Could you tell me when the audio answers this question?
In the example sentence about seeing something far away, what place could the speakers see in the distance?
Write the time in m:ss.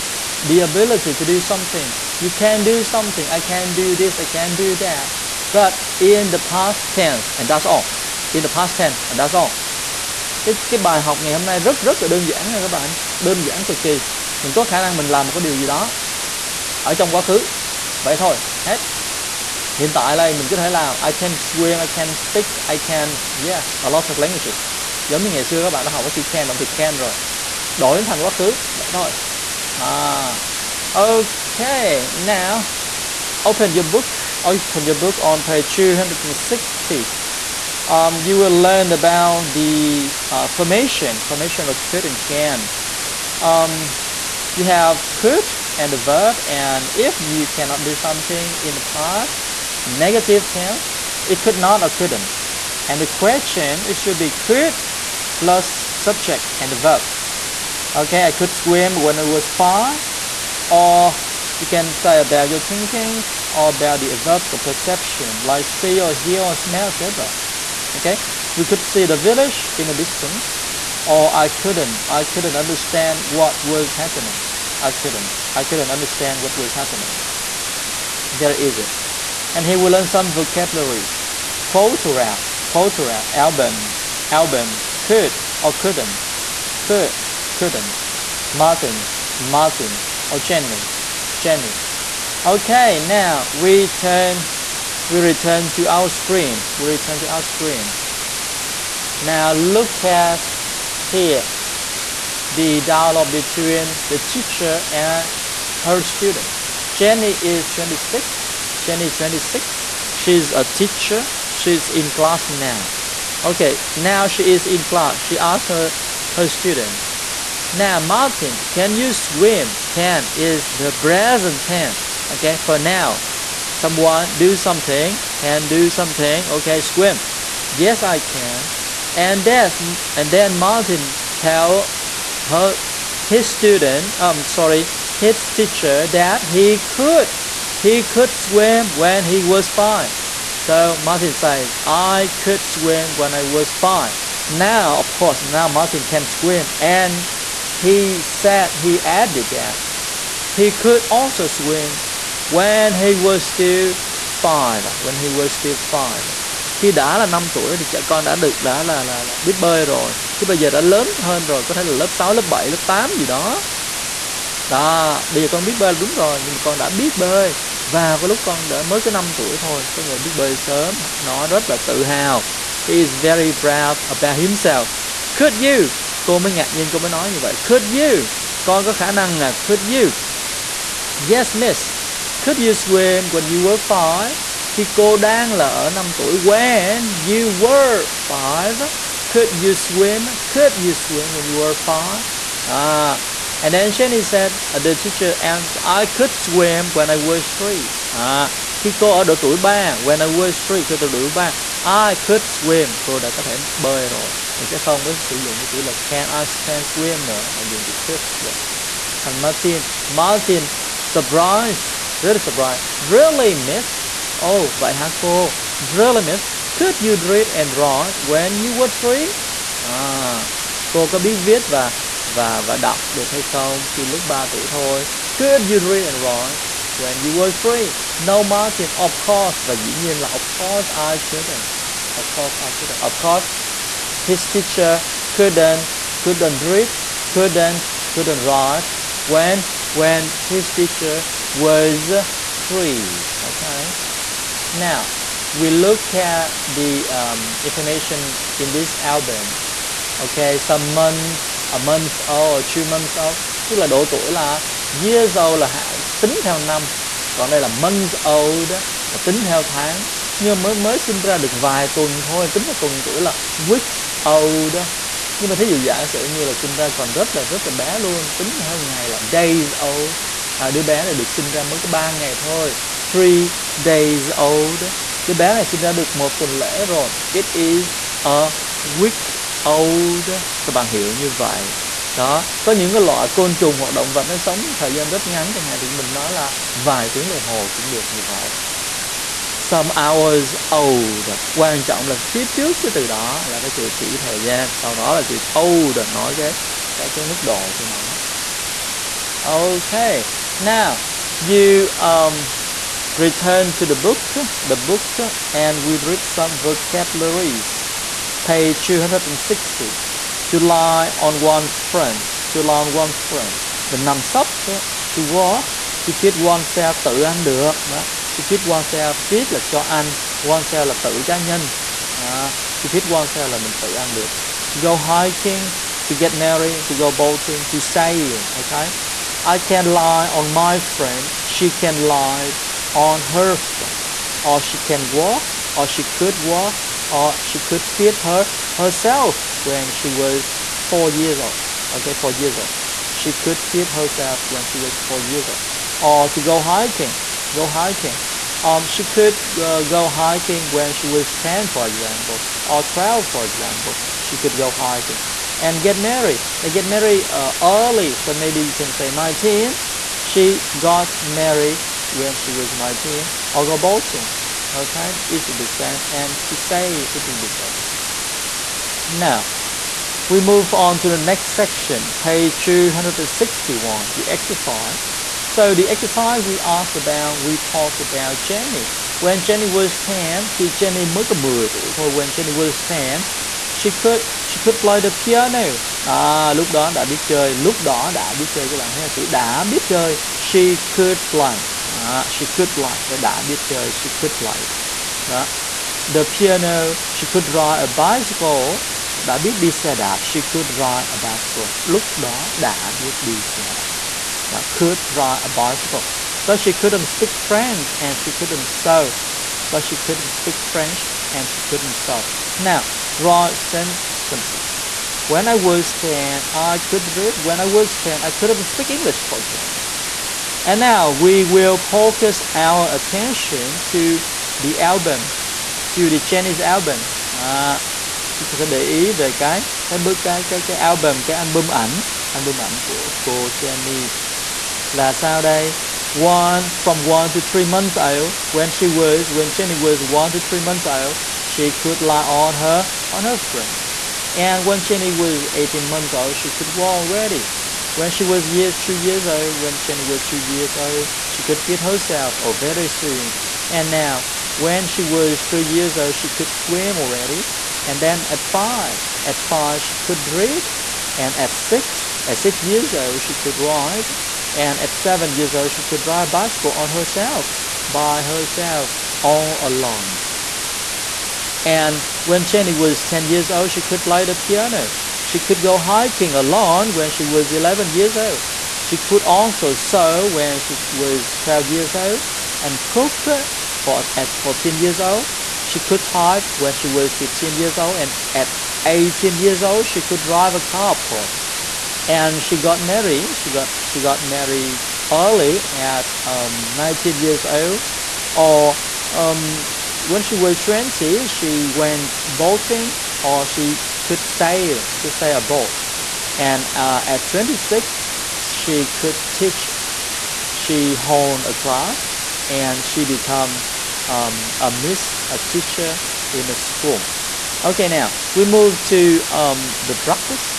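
1:09.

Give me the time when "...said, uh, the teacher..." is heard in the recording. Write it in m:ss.
3:14.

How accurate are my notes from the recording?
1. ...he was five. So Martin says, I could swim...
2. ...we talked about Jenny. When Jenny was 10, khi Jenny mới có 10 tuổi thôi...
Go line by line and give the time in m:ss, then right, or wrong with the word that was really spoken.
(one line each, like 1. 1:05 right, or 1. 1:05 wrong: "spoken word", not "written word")
1. 2:19 right
2. 6:17 right.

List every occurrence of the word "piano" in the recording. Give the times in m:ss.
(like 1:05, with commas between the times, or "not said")
6:25, 6:36, 7:54.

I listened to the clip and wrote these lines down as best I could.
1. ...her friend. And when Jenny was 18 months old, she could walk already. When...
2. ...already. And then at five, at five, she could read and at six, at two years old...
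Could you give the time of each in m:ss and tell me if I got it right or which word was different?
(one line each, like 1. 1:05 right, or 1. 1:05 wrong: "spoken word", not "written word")
1. 7:23 right
2. 7:36 wrong: "six", not "two".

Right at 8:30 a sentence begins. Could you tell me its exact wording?
She honed a class, and she became um, a miss, a teacher in a school.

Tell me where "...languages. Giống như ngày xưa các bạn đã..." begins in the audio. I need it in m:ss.
0:24.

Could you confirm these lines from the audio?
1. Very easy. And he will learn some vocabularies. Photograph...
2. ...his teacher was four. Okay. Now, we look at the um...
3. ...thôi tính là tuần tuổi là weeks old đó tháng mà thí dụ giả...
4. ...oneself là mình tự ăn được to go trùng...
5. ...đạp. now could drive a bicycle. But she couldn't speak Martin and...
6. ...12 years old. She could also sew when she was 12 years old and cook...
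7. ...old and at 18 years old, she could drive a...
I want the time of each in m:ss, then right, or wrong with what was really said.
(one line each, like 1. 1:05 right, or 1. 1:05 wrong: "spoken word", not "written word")
1. 1:18 right
2. 4:00 wrong: "three", not "four"
3. 4:22 wrong: "nhưng", not "tháng"
4. 5:23 wrong: "hiking", not "trùng"
5. 6:43 wrong: "French", not "Martin"
6. 7:57 wrong: "11", not "12"
7. 8:07 right.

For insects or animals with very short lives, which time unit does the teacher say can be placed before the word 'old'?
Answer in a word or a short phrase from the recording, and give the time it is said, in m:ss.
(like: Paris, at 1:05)
hours, at 4:49.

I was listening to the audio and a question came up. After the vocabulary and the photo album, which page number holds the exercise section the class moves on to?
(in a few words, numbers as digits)
261.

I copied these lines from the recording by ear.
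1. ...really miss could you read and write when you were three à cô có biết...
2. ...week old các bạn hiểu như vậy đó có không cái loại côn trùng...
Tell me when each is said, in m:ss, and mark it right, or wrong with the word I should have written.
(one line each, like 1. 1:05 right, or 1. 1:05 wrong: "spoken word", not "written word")
1. 3:35 right
2. 4:38 wrong: "những", not "không".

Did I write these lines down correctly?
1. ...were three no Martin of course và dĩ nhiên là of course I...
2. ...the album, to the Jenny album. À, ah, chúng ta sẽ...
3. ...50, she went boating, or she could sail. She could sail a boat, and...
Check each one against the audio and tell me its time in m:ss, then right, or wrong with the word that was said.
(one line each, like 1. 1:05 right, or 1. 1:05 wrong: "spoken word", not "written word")
1. 3:47 right
2. 7:04 wrong: "Chinese", not "Jenny"
3. 8:20 wrong: "20", not "50".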